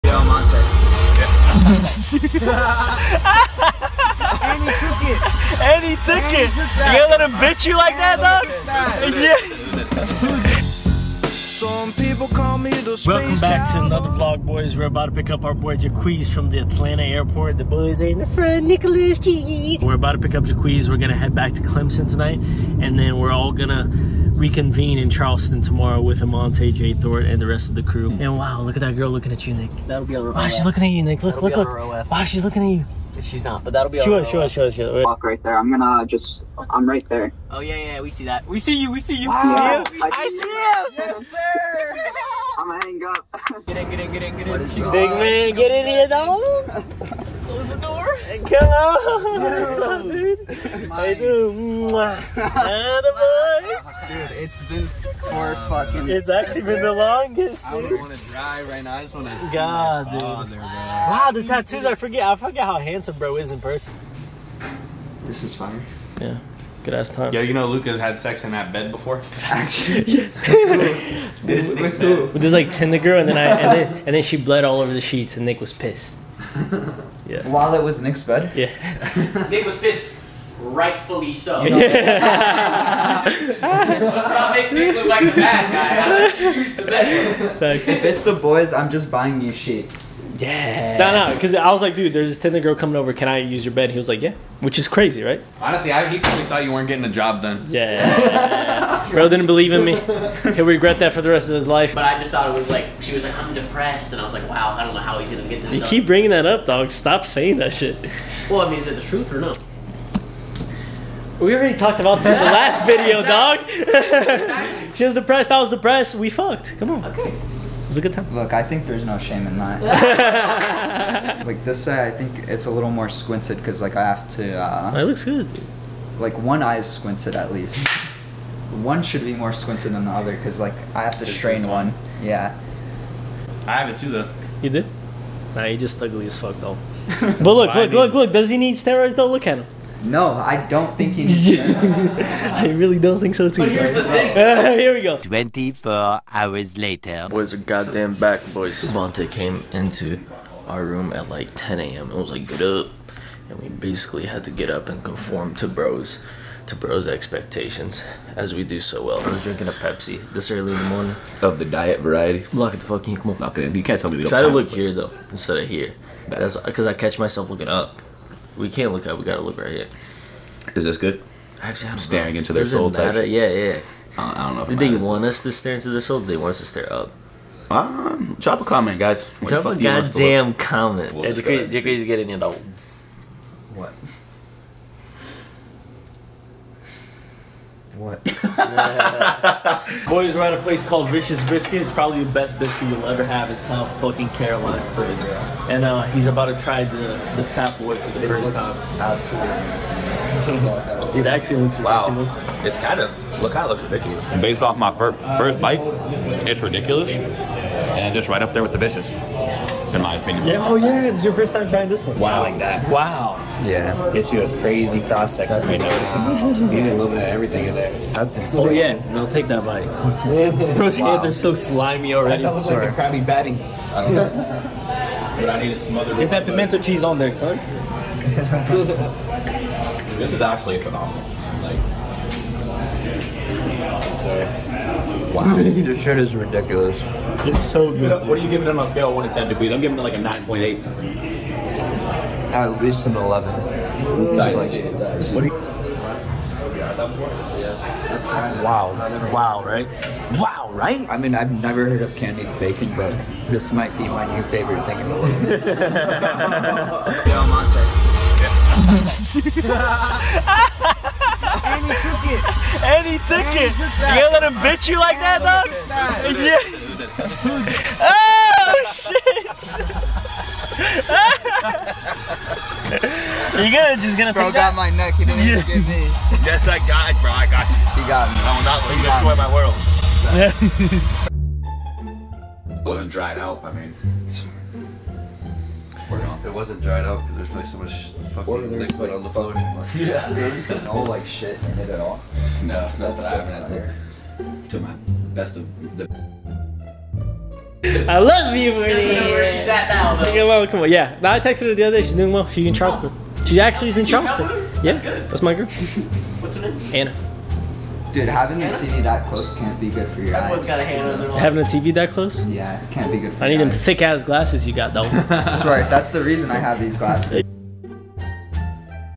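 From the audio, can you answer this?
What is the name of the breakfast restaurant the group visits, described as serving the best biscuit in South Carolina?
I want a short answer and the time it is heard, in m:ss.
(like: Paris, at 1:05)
Vicious Biscuit, at 3:11.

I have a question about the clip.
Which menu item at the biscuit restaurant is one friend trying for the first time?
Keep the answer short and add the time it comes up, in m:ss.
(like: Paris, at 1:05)
the Fat Boy, at 3:17.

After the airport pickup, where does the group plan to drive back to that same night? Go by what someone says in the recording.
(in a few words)
Clemson.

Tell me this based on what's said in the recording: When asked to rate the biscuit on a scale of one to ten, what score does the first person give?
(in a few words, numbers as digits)
9.8.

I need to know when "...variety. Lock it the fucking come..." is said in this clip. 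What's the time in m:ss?
2:41.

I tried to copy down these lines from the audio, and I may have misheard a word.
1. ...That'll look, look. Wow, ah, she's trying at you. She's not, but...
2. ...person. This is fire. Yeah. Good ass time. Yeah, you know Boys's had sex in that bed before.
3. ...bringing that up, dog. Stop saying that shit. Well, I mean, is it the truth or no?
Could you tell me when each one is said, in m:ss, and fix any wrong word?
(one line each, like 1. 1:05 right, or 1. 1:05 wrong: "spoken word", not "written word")
1. 0:31 wrong: "looking", not "trying"
2. 1:03 wrong: "Luca", not "Boys"
3. 1:46 right.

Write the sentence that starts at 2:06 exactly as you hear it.
Like one eye is squinted at least.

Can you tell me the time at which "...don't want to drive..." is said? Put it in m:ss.
0:57.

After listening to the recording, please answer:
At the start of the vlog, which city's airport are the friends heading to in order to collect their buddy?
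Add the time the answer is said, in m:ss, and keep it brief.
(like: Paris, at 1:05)
Atlanta, at 0:16.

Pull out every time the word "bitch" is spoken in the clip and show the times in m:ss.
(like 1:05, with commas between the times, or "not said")
0:07, 4:24.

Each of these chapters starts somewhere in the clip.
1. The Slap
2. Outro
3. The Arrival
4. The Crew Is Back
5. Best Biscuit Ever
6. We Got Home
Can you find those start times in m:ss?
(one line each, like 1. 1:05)
1. 4:17
2. 4:41
3. 0:13
4. 2:27
5. 3:10
6. 1:03.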